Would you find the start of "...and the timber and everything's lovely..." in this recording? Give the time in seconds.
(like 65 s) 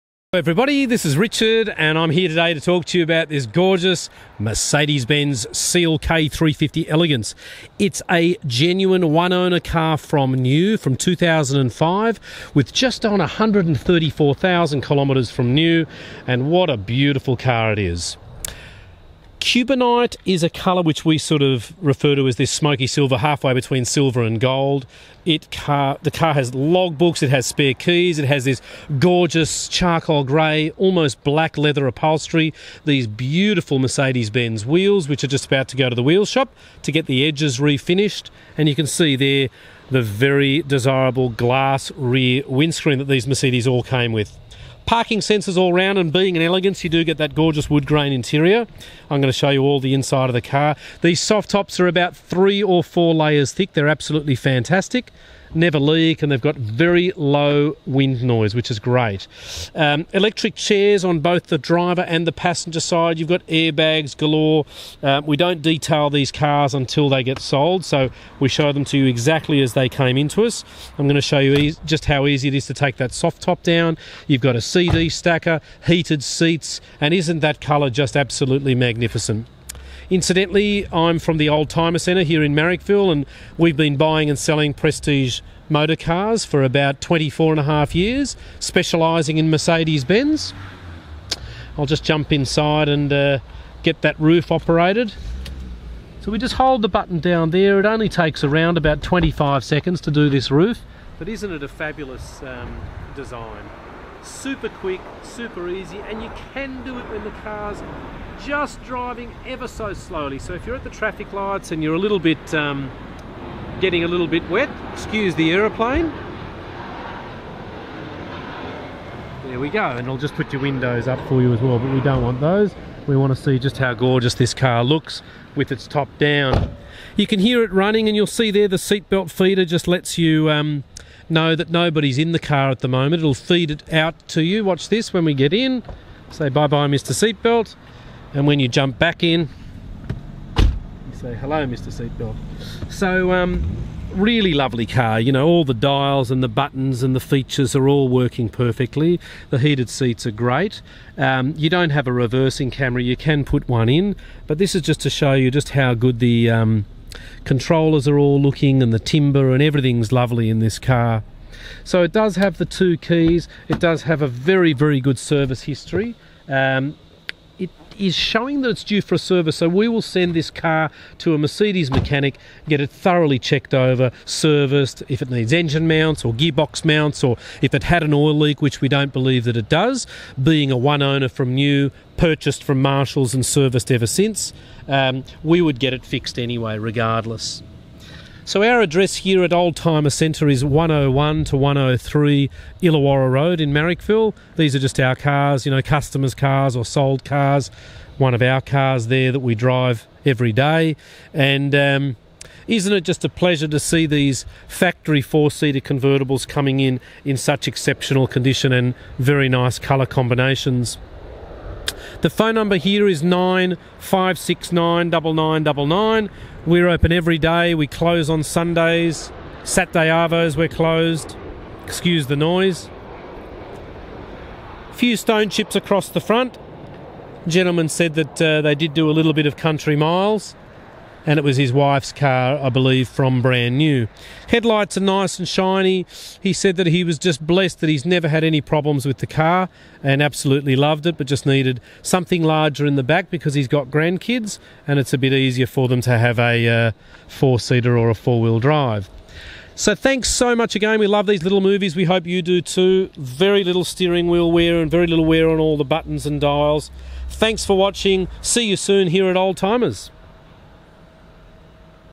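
158 s.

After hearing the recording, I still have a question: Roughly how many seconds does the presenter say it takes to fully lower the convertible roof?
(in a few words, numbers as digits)
25 seconds.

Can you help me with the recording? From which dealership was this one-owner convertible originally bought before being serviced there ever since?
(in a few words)
Marshalls.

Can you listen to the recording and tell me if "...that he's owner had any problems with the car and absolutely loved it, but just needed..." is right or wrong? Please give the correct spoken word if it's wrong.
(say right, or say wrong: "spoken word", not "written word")
wrong: "never", not "owner".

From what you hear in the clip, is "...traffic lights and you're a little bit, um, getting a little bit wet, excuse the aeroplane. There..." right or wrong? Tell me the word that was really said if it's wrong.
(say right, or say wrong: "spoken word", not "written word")
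right.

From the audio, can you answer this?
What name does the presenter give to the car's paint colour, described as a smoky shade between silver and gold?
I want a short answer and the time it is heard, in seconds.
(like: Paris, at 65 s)
Cubanite, at 19 s.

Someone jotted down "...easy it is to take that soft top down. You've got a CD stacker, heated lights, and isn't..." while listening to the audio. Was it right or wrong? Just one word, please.
wrong.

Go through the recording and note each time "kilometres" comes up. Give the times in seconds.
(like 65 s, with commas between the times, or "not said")
14 s.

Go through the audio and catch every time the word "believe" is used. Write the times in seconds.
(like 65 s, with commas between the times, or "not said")
179 s, 232 s.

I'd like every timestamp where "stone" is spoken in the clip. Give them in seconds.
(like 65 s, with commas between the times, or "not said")
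225 s.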